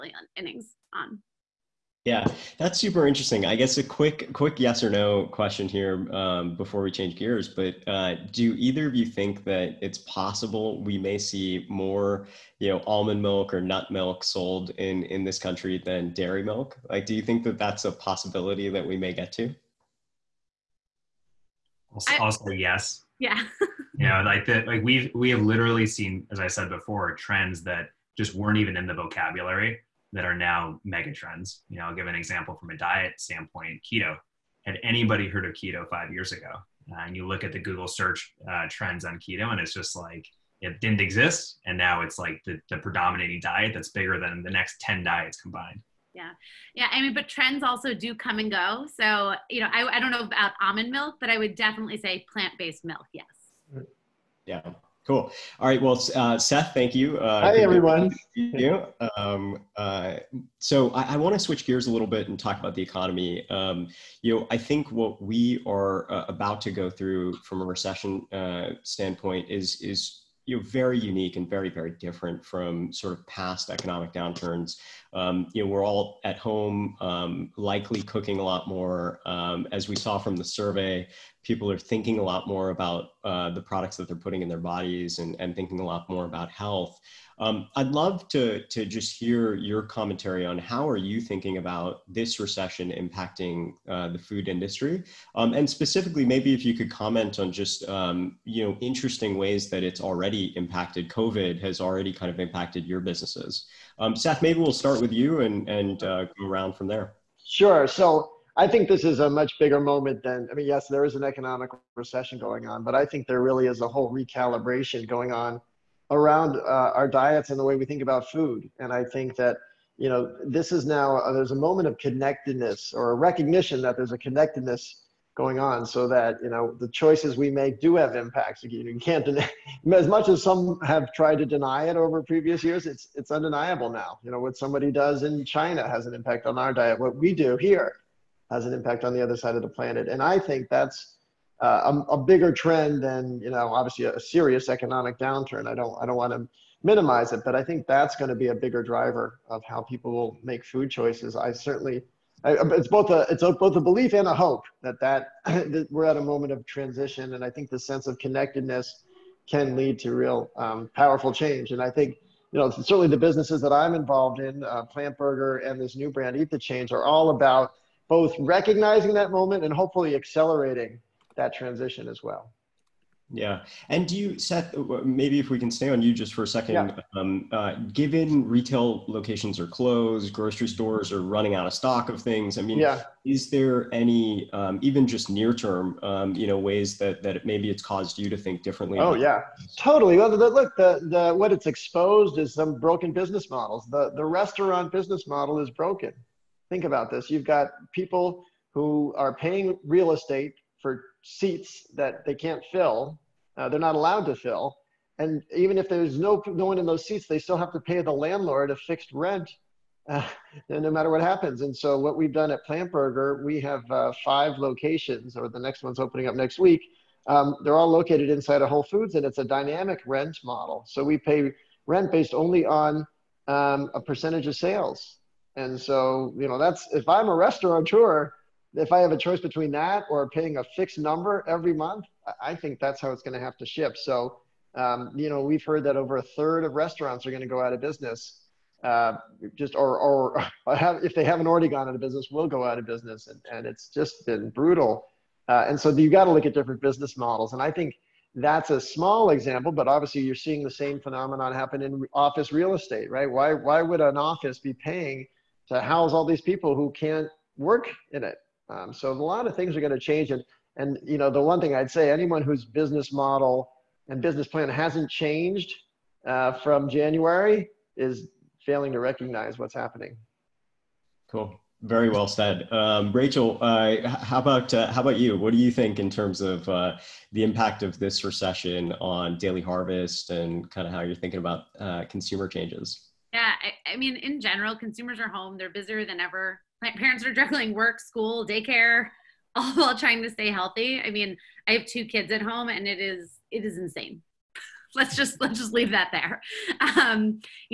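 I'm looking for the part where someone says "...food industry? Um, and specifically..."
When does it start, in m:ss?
1:34.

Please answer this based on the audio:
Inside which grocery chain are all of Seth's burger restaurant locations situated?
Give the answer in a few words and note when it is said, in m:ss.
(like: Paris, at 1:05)
Whole Foods, at 3:38.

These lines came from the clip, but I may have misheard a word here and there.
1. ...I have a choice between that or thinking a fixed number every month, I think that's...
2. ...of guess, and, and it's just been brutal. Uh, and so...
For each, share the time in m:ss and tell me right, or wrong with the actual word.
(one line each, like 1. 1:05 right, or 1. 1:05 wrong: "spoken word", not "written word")
1. 3:48 wrong: "paying", not "thinking"
2. 4:02 wrong: "business", not "guess".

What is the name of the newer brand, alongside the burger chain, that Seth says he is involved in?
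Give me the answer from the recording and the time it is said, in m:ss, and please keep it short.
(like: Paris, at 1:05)
Eat the Change, at 2:46.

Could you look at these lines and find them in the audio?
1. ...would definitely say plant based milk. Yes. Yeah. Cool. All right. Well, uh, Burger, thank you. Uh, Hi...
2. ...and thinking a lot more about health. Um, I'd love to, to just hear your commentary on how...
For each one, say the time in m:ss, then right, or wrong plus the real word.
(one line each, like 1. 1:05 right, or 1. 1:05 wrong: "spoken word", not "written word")
1. 0:51 wrong: "Seth", not "Burger"
2. 1:25 right.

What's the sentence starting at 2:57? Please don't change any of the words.
um, uh, given retail locations are closed, grocery stores are running out of stock of things, I mean, yeah.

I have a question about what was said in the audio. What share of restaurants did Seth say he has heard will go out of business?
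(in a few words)
over a third.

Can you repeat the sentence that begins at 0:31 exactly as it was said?
You know, I'll give an example from a diet standpoint: keto.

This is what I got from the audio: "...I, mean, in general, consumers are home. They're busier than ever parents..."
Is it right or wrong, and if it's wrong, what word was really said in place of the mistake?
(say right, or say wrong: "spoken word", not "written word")
right.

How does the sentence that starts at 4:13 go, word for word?
Why why would an office be paying to house all these people who can't work in it?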